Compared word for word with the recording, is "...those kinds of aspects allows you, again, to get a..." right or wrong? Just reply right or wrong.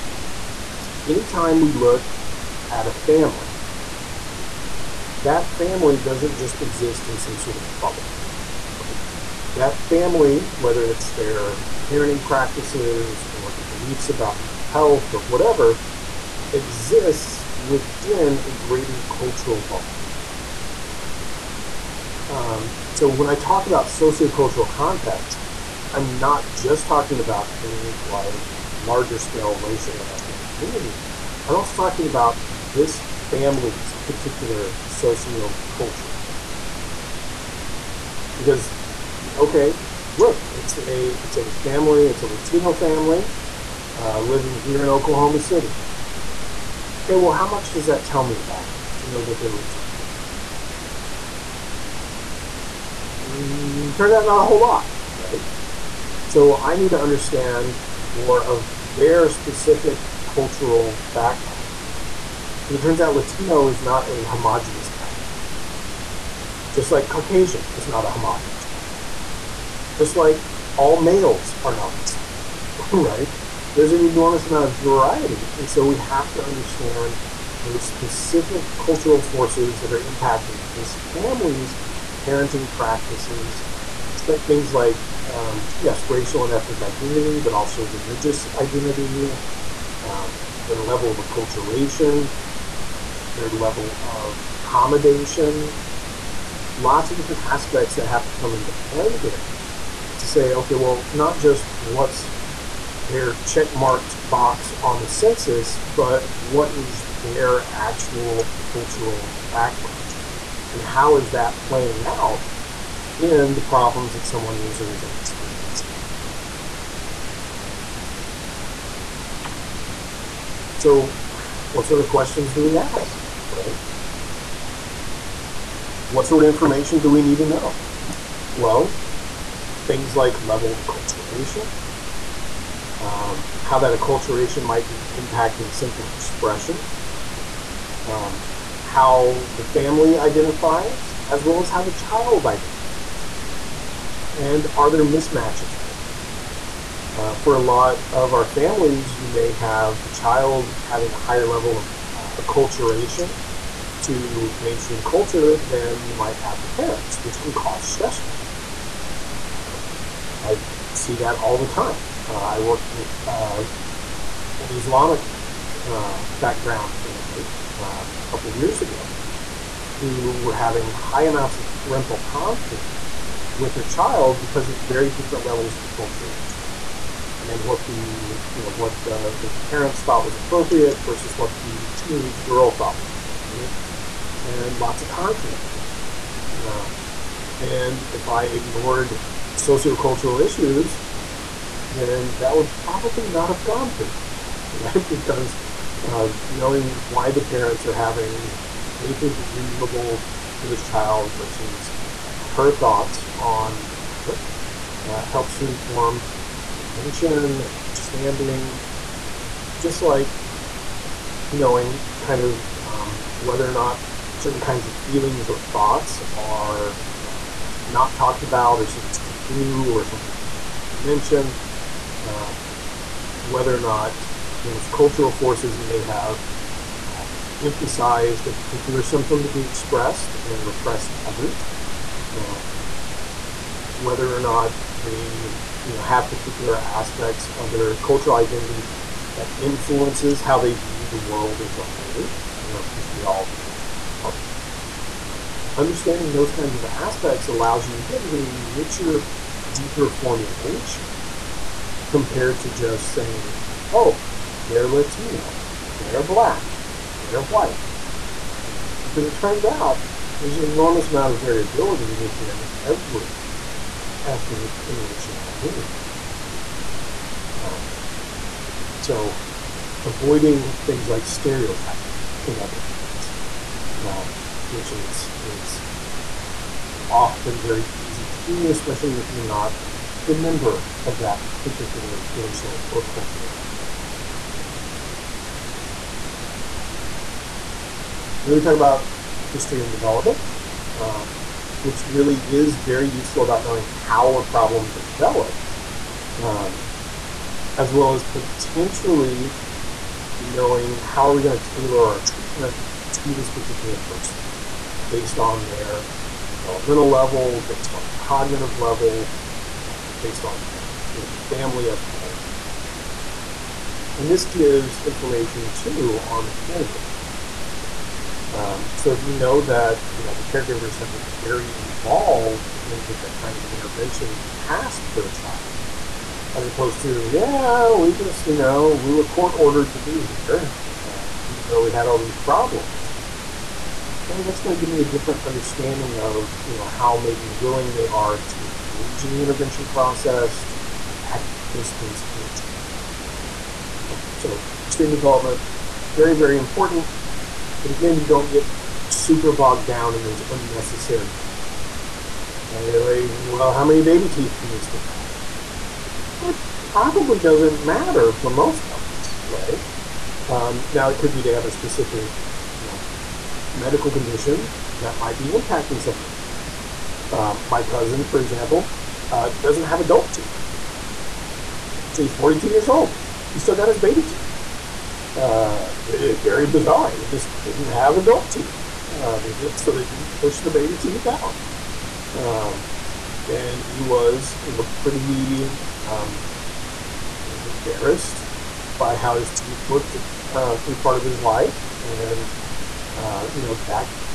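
right.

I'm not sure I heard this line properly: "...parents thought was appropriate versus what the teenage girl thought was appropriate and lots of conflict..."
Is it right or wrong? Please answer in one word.
right.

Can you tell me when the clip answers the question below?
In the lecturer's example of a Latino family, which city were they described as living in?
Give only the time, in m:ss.
0:44.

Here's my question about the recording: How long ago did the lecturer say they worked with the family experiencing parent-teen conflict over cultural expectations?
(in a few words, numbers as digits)
A couple years ago.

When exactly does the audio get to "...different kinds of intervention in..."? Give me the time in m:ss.
5:23.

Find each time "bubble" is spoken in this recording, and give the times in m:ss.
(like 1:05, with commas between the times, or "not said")
0:07, 0:19.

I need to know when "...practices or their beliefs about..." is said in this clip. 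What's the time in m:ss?
0:12.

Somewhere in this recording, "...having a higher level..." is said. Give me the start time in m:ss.
2:30.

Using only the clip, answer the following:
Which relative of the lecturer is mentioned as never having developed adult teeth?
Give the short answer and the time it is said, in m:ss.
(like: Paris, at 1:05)
Cousin, at 6:07.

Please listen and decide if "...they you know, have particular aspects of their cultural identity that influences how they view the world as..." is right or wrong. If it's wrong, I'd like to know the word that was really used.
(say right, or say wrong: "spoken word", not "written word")
right.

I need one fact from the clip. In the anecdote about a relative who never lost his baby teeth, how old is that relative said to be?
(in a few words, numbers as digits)
42.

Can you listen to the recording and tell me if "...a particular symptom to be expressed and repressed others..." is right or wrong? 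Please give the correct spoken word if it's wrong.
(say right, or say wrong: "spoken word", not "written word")
right.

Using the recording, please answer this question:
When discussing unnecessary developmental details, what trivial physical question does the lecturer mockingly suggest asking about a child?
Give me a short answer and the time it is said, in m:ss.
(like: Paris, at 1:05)
How many baby teeth, at 5:53.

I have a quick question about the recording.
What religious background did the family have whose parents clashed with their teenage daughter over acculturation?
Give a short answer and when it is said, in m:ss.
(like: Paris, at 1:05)
Islamic, at 2:44.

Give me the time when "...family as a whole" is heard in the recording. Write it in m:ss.
5:11.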